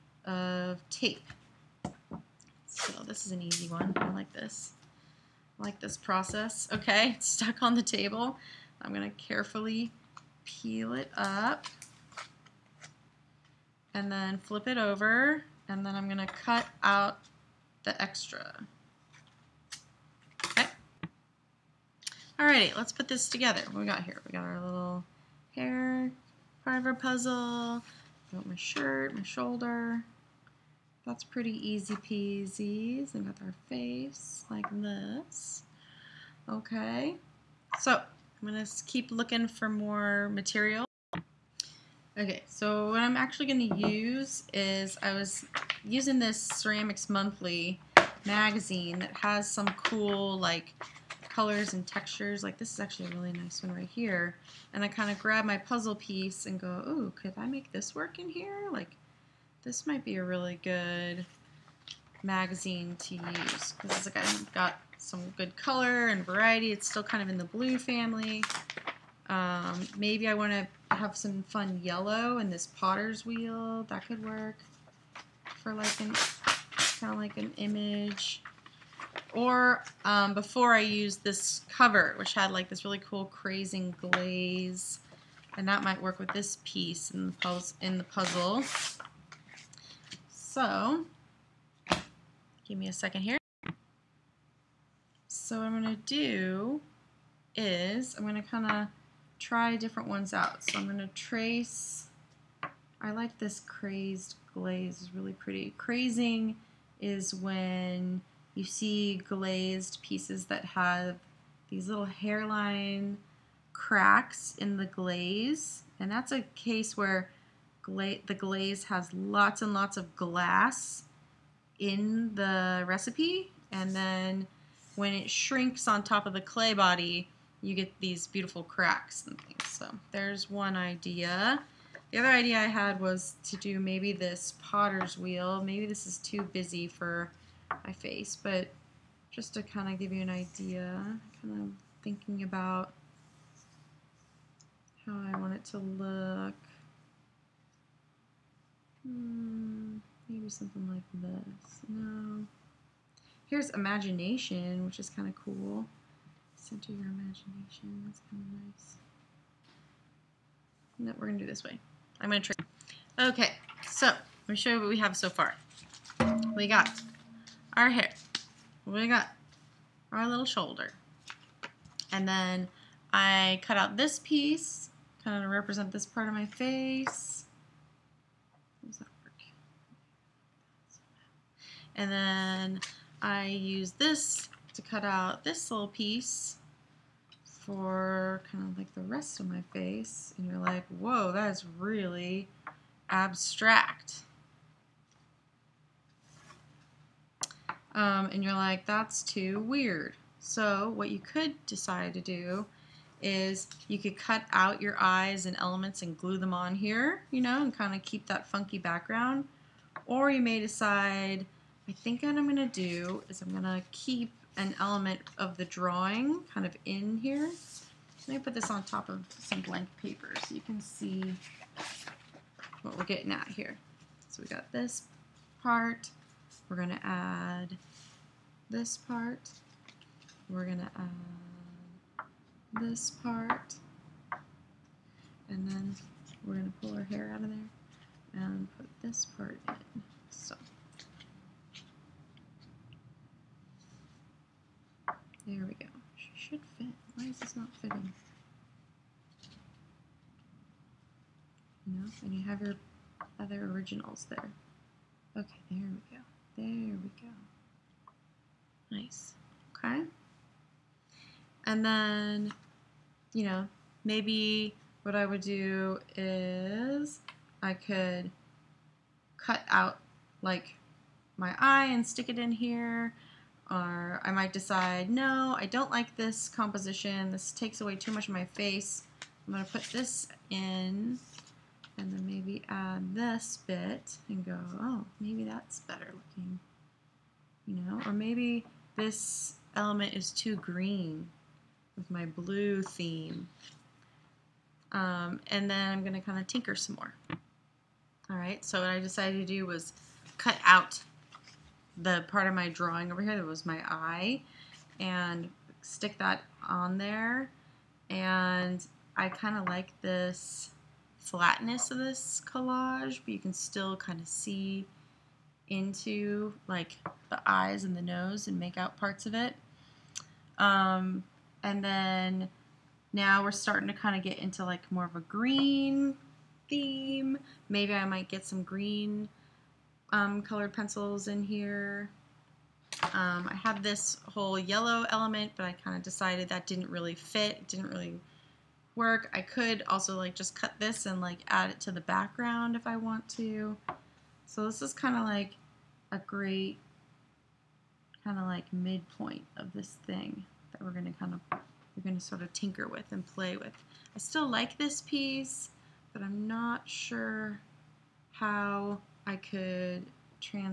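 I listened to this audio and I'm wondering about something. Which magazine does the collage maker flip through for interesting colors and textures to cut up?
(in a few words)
Ceramics Monthly.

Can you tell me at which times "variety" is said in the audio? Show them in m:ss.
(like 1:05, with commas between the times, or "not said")
1:06.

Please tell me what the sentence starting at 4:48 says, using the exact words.
Or maybe this element is too green with my blue theme.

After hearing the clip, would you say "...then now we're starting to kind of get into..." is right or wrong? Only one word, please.
right.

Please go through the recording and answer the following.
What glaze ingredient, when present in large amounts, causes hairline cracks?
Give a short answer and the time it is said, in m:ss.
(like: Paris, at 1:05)
Glass, at 2:00.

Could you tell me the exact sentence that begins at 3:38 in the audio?
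Let me put this on top of some blank paper so you can see what we're getting at here.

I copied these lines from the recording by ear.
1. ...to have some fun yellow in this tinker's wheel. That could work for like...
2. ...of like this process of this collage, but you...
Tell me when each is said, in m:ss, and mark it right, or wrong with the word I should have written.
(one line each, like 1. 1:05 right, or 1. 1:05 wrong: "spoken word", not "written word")
1. 1:10 wrong: "potter", not "tinker"
2. 5:09 wrong: "flatness", not "process".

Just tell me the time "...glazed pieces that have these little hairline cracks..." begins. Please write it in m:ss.
1:49.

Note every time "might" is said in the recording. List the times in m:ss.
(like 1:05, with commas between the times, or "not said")
0:59, 1:25, 4:34, 5:28.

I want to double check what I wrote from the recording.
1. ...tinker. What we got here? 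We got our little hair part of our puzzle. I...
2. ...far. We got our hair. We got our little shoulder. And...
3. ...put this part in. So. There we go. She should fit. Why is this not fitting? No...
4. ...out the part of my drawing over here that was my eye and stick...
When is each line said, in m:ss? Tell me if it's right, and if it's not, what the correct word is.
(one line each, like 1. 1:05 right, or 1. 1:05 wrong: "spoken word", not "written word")
1. 0:23 wrong: "together", not "tinker"
2. 2:45 right
3. 3:58 right
4. 5:00 right.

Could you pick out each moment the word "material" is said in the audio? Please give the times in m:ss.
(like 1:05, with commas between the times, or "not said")
0:40.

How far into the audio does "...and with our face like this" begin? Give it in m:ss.
0:33.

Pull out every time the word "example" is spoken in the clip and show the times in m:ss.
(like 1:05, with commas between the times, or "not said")
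not said.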